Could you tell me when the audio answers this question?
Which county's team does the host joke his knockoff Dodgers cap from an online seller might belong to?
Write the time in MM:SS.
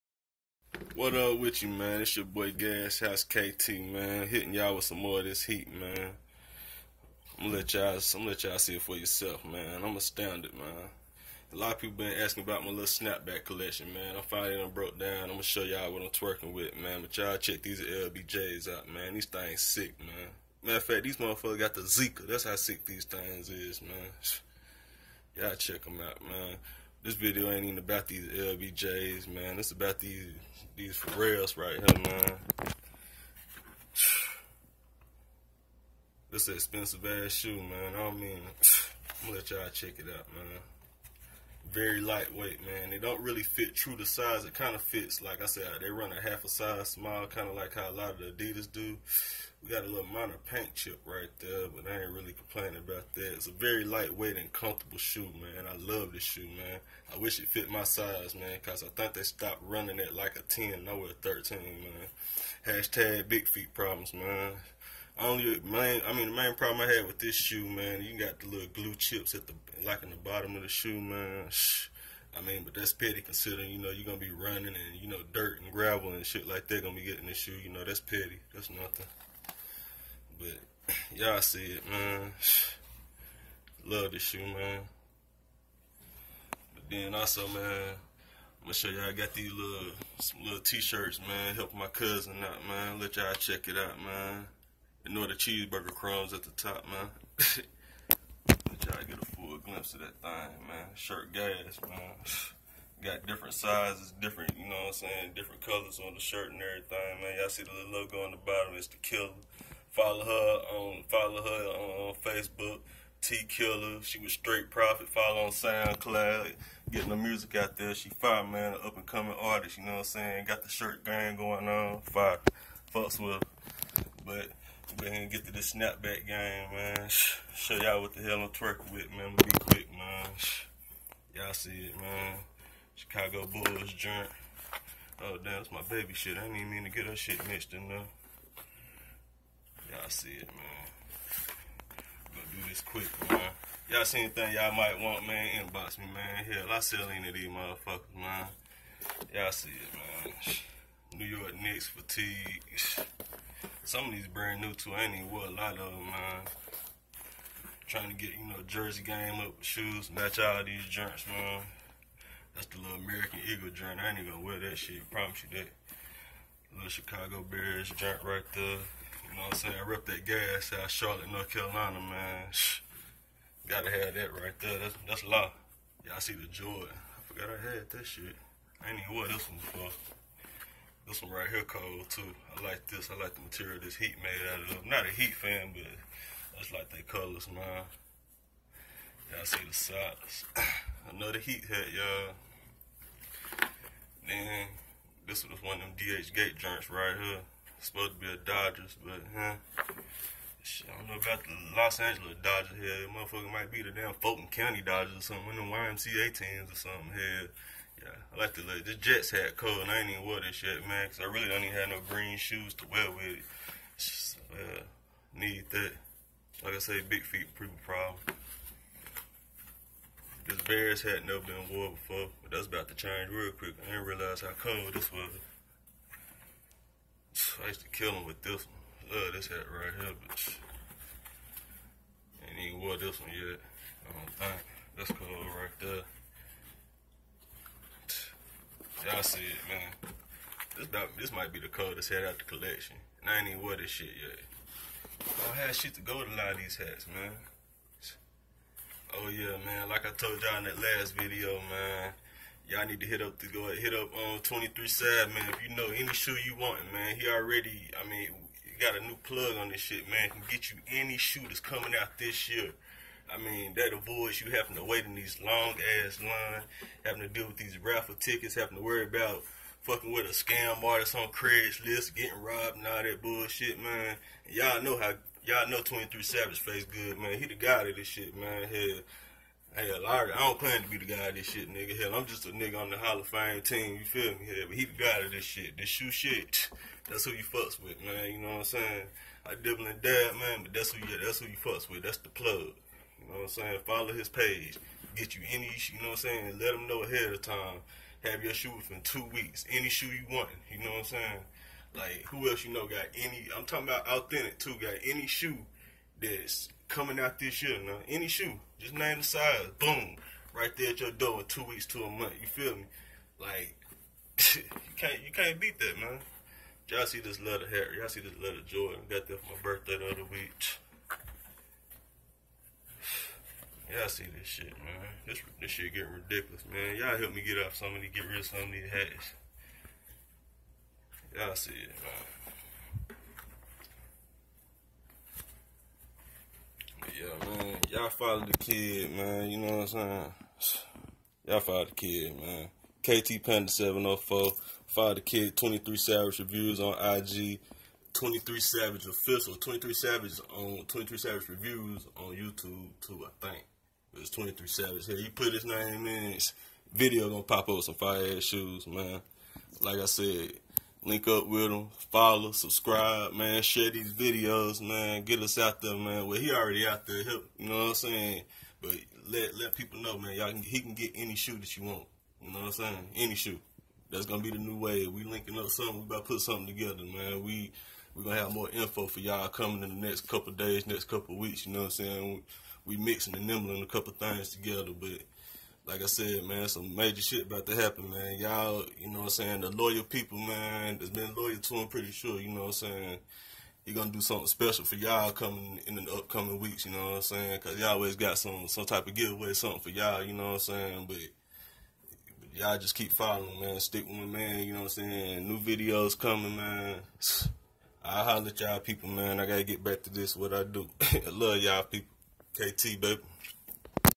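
03:24.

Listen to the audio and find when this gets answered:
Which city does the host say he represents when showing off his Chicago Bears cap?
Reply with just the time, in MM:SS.
02:50.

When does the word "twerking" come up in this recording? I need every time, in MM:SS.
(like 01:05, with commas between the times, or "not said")
00:16, 02:08.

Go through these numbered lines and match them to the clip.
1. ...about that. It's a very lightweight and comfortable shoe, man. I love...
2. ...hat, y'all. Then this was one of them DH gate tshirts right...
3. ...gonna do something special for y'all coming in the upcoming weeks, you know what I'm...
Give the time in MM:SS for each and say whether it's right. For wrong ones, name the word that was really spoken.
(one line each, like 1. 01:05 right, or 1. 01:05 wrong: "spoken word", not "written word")
1. 00:52 right
2. 03:11 wrong: "joints", not "tshirts"
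3. 06:33 right.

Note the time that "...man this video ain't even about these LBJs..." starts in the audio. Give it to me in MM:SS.
00:26.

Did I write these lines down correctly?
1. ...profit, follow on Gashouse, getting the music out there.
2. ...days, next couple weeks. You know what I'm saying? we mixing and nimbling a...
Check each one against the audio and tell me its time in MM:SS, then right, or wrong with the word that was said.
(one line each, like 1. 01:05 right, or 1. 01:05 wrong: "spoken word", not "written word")
1. 01:54 wrong: "SoundCloud", not "Gashouse"
2. 06:20 right.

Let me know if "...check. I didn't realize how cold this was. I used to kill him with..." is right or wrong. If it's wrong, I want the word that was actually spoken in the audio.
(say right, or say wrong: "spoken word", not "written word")
wrong: "quick", not "check".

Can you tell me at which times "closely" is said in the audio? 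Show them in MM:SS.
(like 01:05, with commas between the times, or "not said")
not said.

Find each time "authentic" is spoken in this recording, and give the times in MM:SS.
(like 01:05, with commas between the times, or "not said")
05:04.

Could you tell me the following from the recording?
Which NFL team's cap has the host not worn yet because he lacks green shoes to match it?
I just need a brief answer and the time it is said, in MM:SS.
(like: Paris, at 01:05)
Jets, at 03:28.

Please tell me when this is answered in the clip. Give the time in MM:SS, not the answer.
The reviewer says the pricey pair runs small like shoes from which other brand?
00:48.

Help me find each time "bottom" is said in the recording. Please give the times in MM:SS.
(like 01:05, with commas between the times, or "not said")
01:10, 01:48.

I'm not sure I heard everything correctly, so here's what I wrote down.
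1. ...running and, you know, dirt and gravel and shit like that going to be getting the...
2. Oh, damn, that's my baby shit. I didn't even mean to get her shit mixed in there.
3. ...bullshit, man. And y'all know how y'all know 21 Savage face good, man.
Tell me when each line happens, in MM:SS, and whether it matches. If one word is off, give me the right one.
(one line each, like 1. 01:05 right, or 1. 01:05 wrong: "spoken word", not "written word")
1. 01:14 right
2. 02:15 right
3. 04:33 wrong: "23", not "21".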